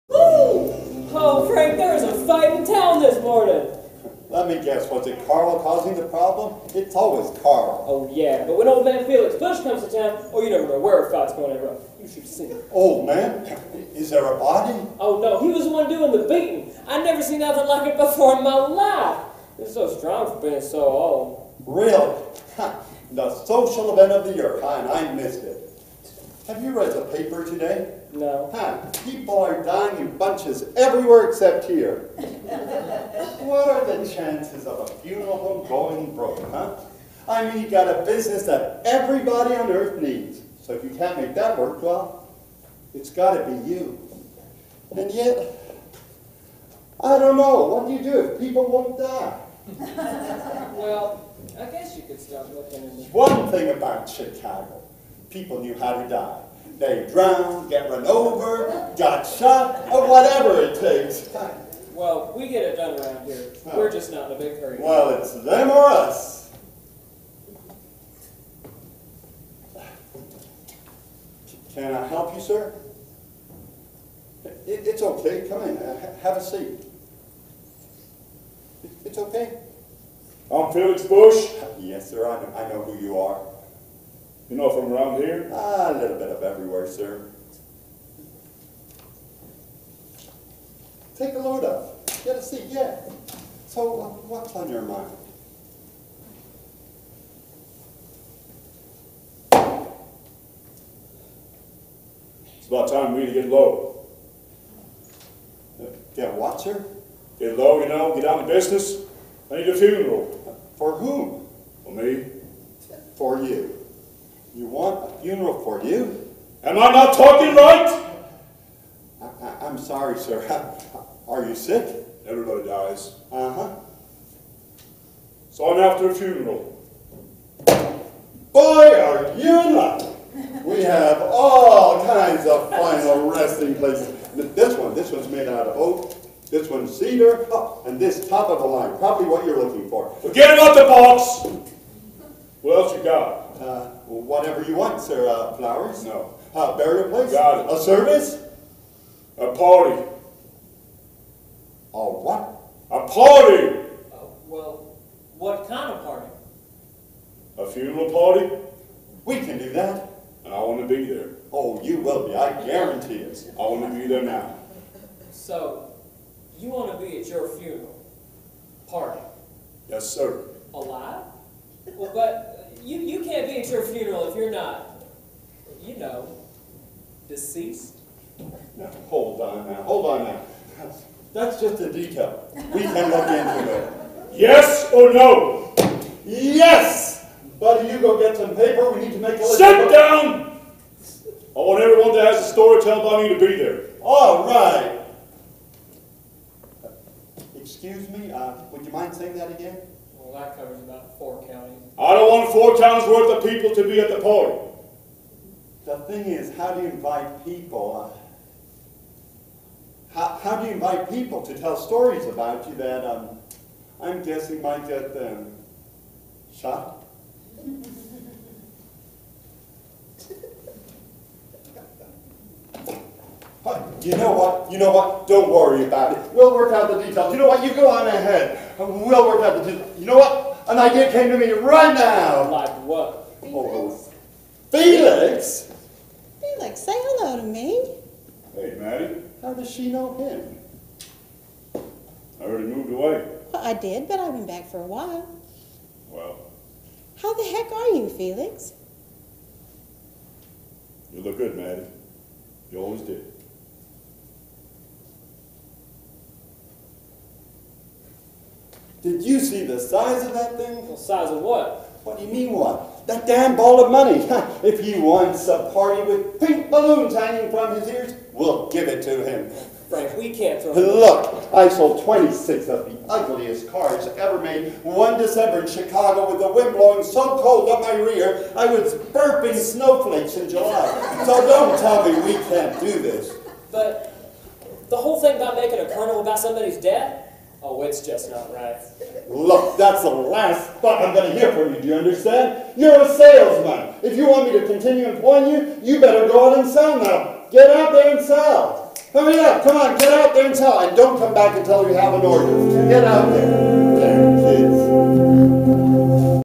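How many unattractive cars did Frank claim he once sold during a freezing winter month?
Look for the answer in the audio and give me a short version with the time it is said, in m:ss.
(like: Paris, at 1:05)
26, at 4:32.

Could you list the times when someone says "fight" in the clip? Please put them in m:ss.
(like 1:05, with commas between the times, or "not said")
0:02, 0:11.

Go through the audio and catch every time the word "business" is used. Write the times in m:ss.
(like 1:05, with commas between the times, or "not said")
0:38, 1:48.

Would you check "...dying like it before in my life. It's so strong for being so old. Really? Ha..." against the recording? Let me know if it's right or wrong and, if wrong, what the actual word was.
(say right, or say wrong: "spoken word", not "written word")
wrong: "nothing", not "dying".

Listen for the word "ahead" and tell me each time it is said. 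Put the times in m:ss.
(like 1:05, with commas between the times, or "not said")
3:48.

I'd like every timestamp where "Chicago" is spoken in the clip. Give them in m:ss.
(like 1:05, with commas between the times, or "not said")
0:54, 4:35.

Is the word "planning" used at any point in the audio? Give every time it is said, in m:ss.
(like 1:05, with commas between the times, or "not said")
not said.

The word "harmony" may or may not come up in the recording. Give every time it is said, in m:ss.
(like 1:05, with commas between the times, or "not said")
not said.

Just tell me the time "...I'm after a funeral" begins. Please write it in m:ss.
2:05.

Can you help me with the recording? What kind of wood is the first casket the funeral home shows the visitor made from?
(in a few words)
Oak.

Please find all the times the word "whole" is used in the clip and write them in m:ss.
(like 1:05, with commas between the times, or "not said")
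4:44.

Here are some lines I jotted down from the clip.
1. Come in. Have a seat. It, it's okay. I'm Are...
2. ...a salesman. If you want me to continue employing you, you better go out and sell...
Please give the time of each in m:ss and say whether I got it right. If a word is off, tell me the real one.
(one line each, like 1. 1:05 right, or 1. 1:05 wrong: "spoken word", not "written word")
1. 1:15 wrong: "Felix", not "Are"
2. 4:53 right.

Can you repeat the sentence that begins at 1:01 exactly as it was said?
Well, we get it done around here.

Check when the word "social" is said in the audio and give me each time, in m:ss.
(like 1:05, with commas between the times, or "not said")
0:23.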